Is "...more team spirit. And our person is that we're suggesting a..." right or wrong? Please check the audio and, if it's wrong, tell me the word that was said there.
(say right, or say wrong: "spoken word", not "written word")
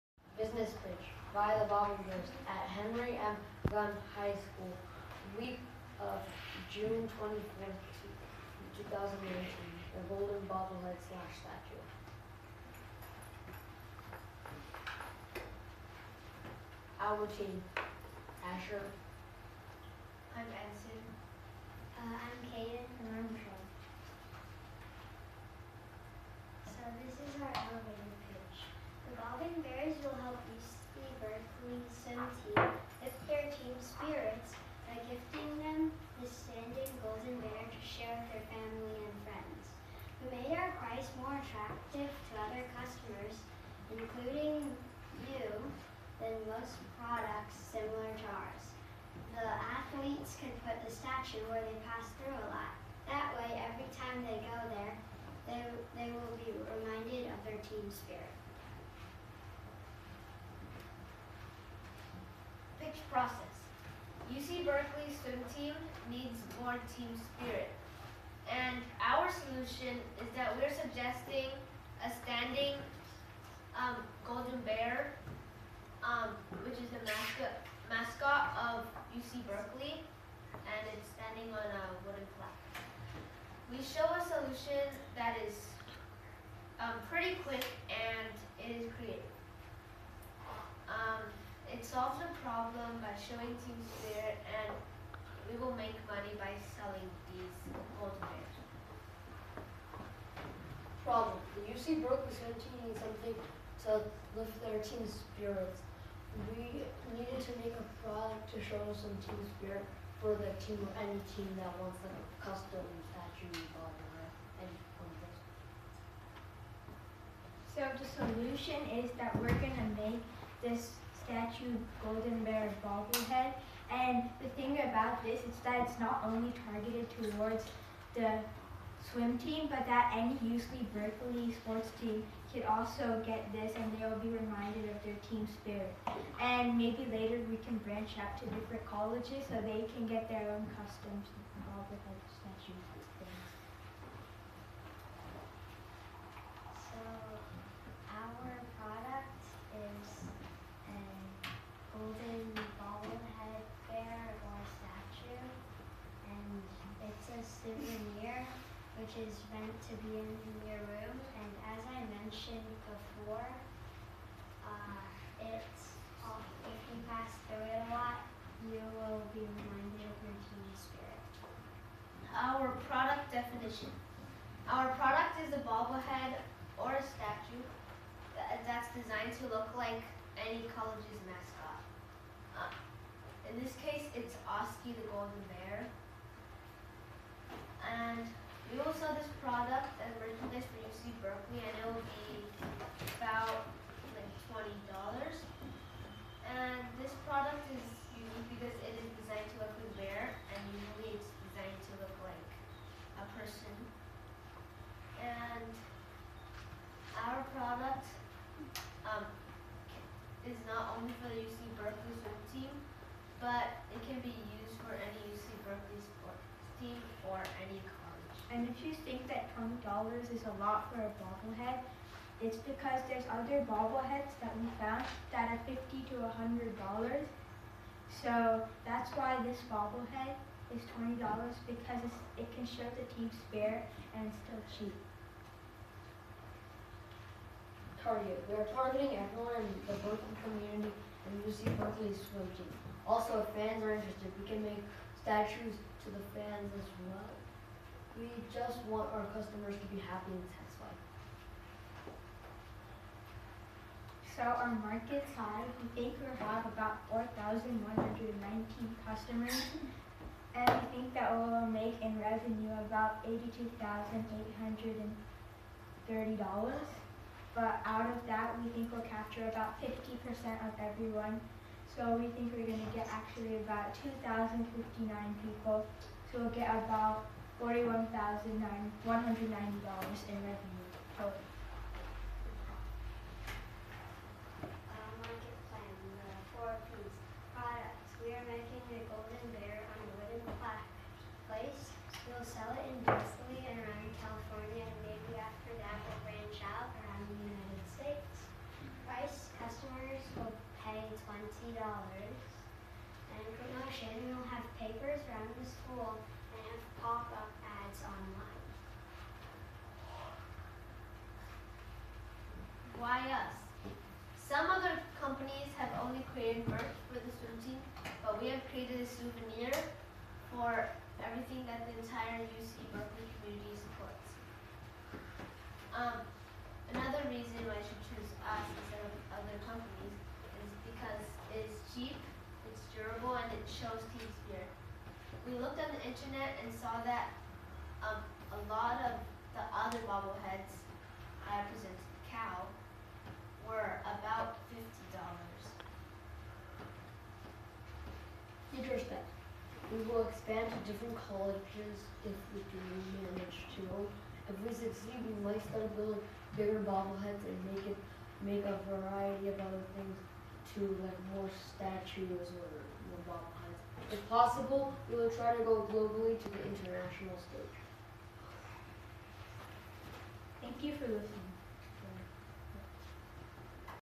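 wrong: "solution", not "person".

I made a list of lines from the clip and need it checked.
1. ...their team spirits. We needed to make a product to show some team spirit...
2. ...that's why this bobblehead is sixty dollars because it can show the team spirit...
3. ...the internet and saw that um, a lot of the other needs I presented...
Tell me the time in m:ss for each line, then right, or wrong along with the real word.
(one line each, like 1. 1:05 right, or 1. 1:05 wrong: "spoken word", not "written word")
1. 1:44 right
2. 3:48 wrong: "twenty", not "sixty"
3. 5:35 wrong: "bobbleheads", not "needs".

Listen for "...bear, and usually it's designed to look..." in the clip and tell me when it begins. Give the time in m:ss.
3:19.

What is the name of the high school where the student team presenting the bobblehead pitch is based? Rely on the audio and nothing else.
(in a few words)
Henry M. 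Gunn High School.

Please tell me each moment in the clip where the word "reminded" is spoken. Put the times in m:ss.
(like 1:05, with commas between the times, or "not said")
0:56, 2:14, 2:49.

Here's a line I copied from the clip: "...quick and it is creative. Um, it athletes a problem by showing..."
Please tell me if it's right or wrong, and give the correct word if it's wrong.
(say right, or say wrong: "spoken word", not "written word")
wrong: "solves", not "athletes".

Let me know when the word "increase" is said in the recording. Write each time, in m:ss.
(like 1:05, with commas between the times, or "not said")
not said.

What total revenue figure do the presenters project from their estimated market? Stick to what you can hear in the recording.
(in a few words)
$82,830.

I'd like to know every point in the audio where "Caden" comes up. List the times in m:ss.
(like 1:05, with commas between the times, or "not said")
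0:22.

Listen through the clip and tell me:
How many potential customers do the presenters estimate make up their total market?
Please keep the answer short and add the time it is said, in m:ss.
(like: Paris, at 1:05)
4,119, at 4:17.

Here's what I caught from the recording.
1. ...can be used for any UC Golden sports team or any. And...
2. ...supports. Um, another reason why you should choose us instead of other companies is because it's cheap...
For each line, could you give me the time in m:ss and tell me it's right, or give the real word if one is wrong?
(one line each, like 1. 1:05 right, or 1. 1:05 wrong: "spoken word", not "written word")
1. 3:34 wrong: "Berkeley", not "Golden"
2. 5:23 right.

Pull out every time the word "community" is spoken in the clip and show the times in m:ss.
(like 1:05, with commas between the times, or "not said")
4:00, 5:23.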